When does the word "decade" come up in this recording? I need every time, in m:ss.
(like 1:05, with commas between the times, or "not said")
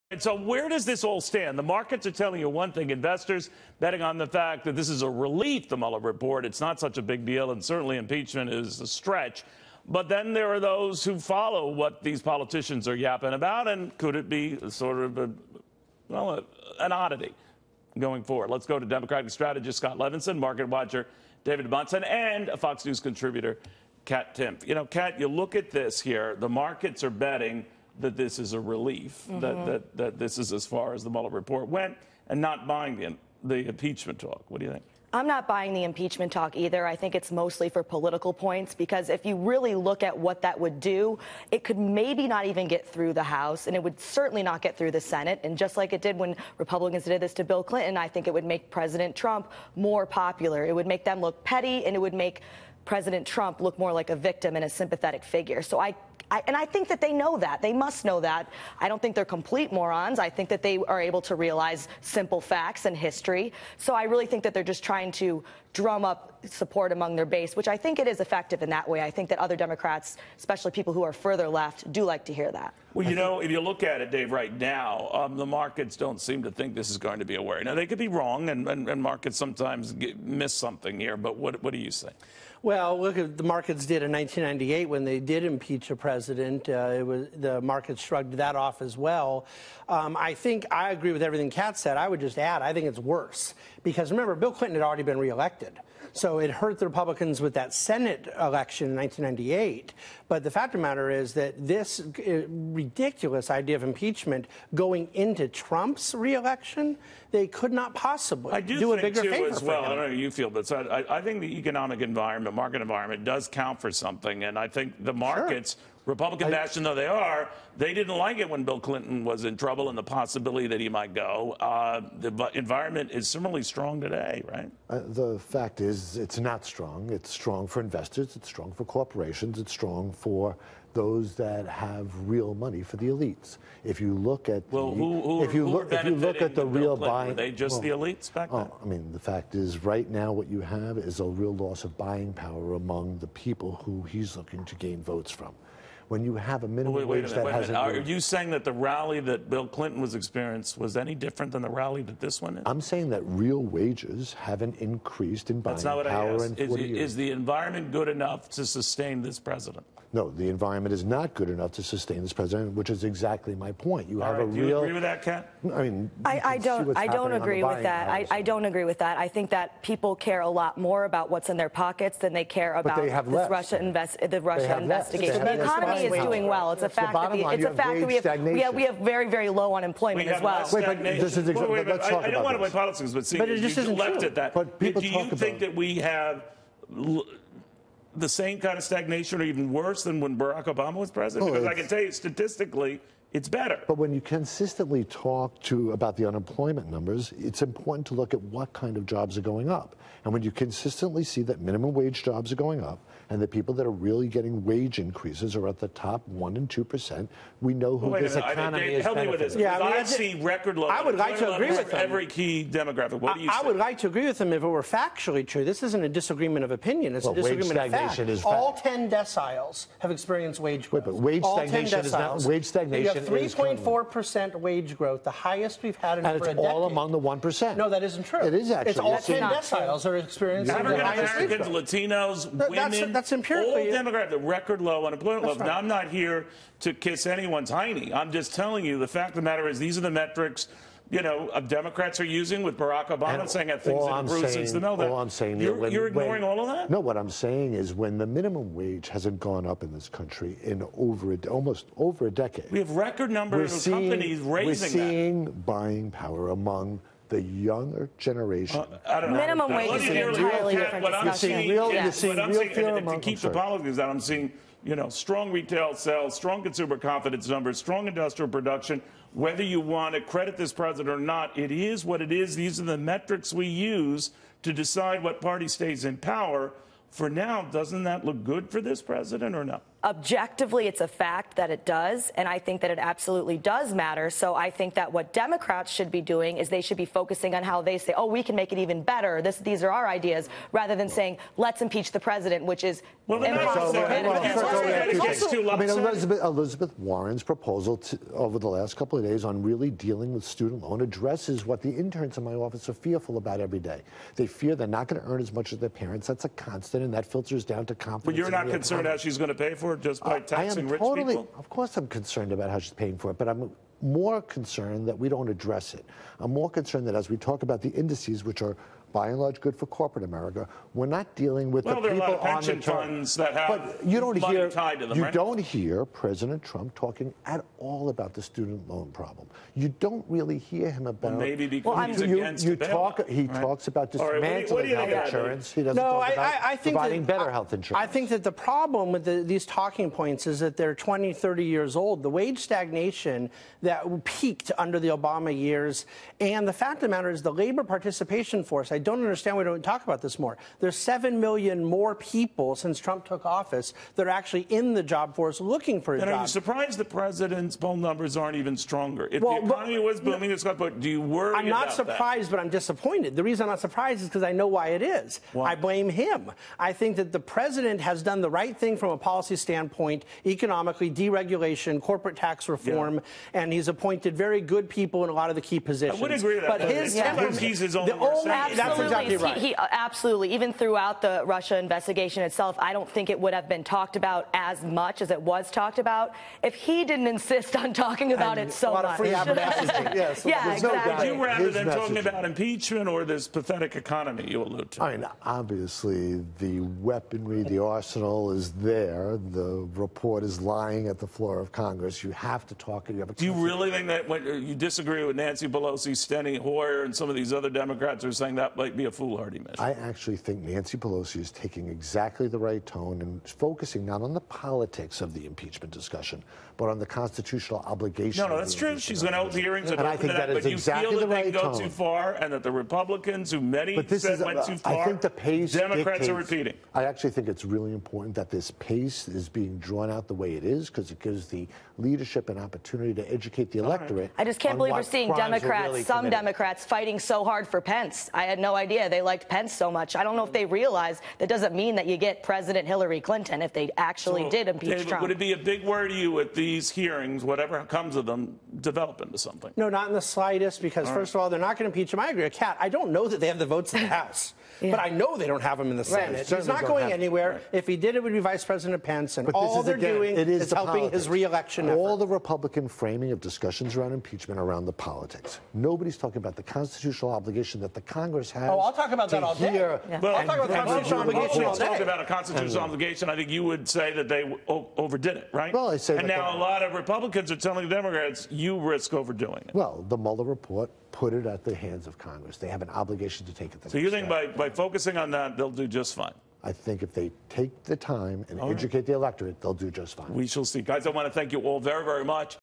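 3:46, 4:12.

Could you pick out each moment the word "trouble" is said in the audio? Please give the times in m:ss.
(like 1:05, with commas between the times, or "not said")
1:59.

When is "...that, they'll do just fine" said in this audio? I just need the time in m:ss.
8:05.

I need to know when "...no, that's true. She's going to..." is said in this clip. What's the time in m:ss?
6:58.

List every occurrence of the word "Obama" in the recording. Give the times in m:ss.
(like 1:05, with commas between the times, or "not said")
3:10, 4:03, 5:45.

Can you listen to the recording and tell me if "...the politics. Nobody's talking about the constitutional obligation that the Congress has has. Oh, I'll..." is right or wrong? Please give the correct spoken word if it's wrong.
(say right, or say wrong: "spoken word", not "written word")
right.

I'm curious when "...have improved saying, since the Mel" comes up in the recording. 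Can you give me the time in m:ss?
4:04.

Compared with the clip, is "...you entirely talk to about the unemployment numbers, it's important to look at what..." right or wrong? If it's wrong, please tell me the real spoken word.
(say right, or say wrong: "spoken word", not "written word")
wrong: "consistently", not "entirely".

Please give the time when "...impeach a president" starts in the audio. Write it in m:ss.
1:25.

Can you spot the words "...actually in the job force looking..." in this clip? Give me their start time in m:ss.
5:54.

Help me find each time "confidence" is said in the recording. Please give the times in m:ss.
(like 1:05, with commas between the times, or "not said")
4:26, 5:07.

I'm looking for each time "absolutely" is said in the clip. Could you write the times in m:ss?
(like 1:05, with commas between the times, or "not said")
4:42, 6:19.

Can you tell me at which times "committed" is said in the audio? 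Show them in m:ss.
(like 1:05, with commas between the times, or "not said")
7:16.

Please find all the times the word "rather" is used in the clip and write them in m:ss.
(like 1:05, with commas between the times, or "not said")
4:50, 6:31.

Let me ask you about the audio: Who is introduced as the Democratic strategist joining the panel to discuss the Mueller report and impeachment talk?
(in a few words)
Scott Levinson.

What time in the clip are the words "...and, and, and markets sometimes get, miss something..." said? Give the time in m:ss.
1:18.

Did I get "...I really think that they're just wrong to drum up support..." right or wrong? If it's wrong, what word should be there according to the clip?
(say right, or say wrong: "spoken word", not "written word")
wrong: "trying", not "wrong".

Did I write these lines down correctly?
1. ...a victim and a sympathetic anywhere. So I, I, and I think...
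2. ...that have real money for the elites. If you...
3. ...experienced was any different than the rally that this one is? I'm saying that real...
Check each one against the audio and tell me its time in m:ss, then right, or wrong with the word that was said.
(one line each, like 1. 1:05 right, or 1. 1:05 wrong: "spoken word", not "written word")
1. 0:54 wrong: "figure", not "anywhere"
2. 2:11 right
3. 2:30 right.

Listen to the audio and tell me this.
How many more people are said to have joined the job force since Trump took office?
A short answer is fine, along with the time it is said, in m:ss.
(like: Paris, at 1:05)
7 million, at 5:50.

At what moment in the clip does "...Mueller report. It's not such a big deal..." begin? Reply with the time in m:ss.
0:05.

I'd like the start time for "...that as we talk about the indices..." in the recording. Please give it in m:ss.
5:17.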